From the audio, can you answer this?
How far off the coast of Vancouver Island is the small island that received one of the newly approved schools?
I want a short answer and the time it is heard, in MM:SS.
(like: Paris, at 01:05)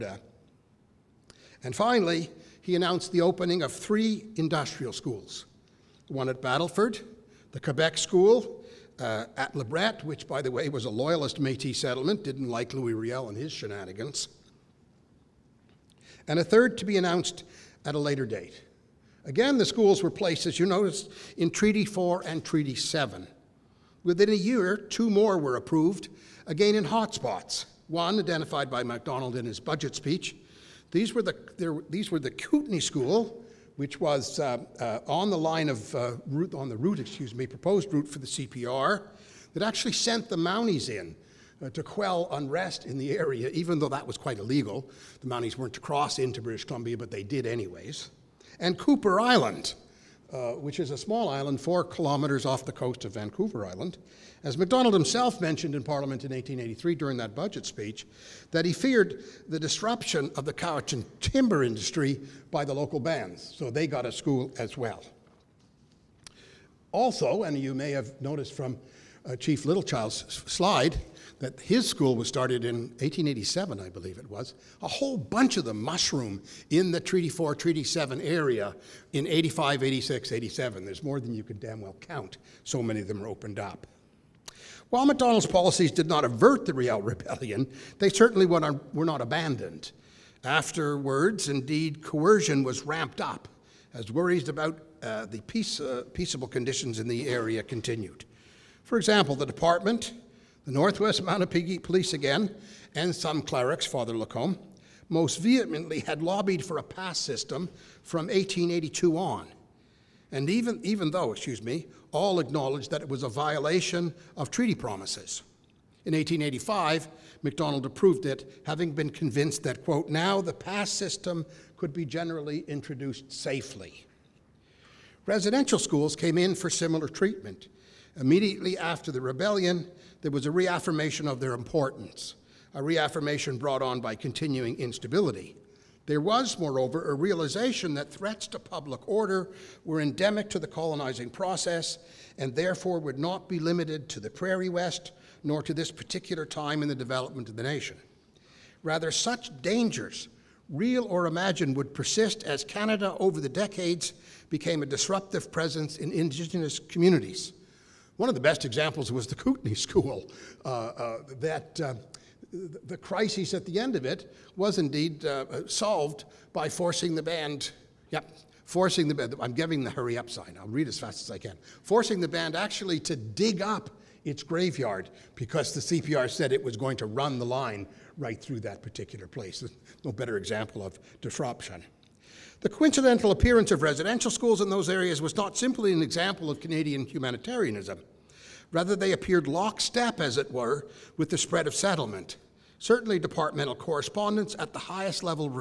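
4 kilometers, at 00:51.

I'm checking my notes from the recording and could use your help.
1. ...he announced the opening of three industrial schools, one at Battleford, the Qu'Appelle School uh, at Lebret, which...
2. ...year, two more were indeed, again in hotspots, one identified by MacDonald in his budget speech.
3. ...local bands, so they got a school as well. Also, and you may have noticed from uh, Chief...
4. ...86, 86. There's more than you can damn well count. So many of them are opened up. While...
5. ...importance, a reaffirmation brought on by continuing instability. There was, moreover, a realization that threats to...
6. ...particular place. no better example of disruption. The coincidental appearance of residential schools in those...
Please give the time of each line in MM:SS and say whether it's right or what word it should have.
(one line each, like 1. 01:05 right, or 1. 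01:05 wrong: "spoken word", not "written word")
1. 00:02 right
2. 00:24 wrong: "approved", not "indeed"
3. 01:02 right
4. 01:19 wrong: "87", not "86"
5. 02:11 right
6. 02:58 right.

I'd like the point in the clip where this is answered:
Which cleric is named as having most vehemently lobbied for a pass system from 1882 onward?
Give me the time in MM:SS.
01:43.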